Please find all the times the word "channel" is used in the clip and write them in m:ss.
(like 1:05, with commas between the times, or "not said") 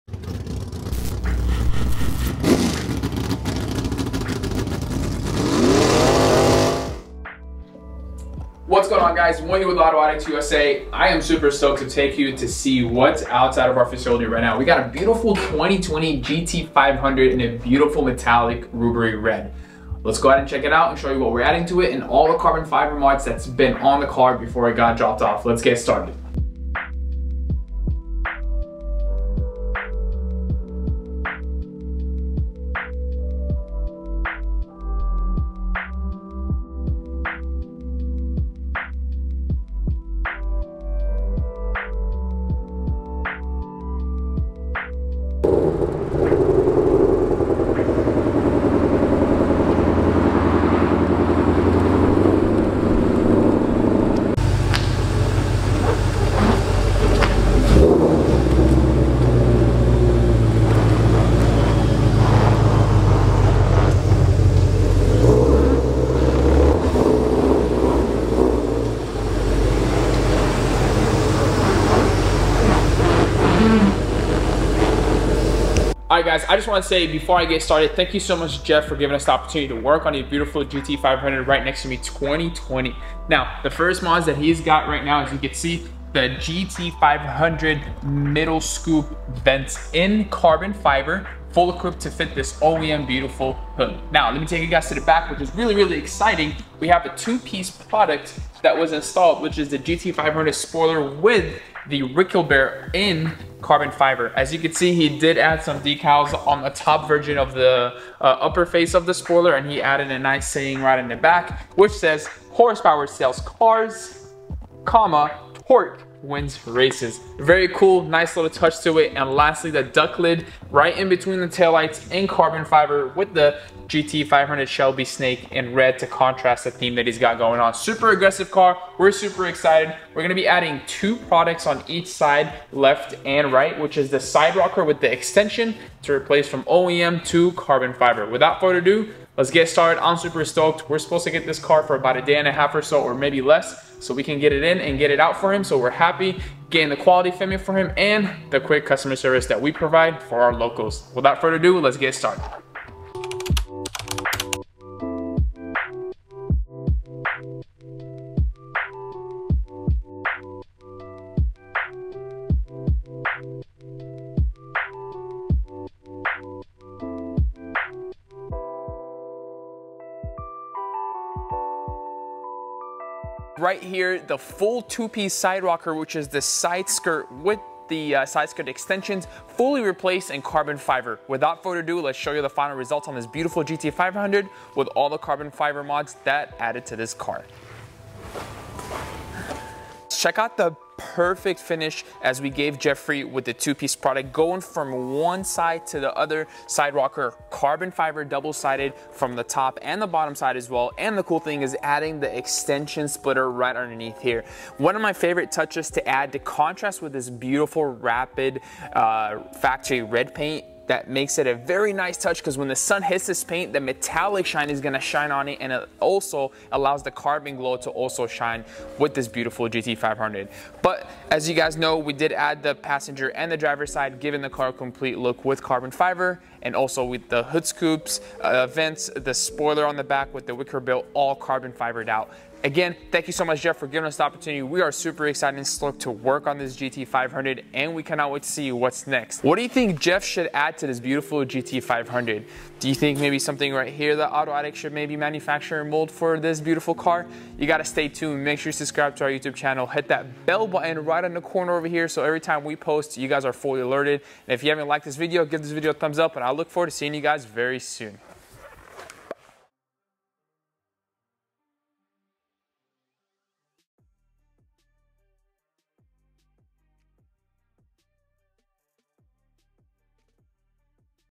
4:09.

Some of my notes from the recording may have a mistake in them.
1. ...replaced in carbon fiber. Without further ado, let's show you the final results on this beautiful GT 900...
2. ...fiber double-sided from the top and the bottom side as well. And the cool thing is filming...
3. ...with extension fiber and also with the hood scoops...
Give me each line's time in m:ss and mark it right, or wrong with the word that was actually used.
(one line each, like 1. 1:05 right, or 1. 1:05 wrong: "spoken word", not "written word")
1. 2:59 wrong: "500", not "900"
2. 3:17 wrong: "adding", not "filming"
3. 3:45 wrong: "carbon", not "extension".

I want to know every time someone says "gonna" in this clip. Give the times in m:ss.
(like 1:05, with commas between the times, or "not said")
2:10, 3:34.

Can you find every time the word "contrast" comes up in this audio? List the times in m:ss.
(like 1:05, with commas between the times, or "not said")
2:06, 3:26.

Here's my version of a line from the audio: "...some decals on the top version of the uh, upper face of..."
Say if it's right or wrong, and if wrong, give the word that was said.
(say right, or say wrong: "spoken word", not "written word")
right.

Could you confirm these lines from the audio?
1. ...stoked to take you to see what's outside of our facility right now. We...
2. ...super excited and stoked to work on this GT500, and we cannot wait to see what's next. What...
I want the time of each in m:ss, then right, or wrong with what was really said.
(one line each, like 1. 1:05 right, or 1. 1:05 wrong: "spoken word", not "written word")
1. 0:11 right
2. 3:54 right.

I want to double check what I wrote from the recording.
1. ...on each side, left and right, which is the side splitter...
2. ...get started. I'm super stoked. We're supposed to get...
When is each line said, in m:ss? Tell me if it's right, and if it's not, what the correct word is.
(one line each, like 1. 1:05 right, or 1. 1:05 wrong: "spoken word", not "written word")
1. 2:11 wrong: "rocker", not "splitter"
2. 2:19 right.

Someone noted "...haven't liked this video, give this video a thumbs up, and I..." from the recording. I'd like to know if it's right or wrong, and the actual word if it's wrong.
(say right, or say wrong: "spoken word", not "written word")
right.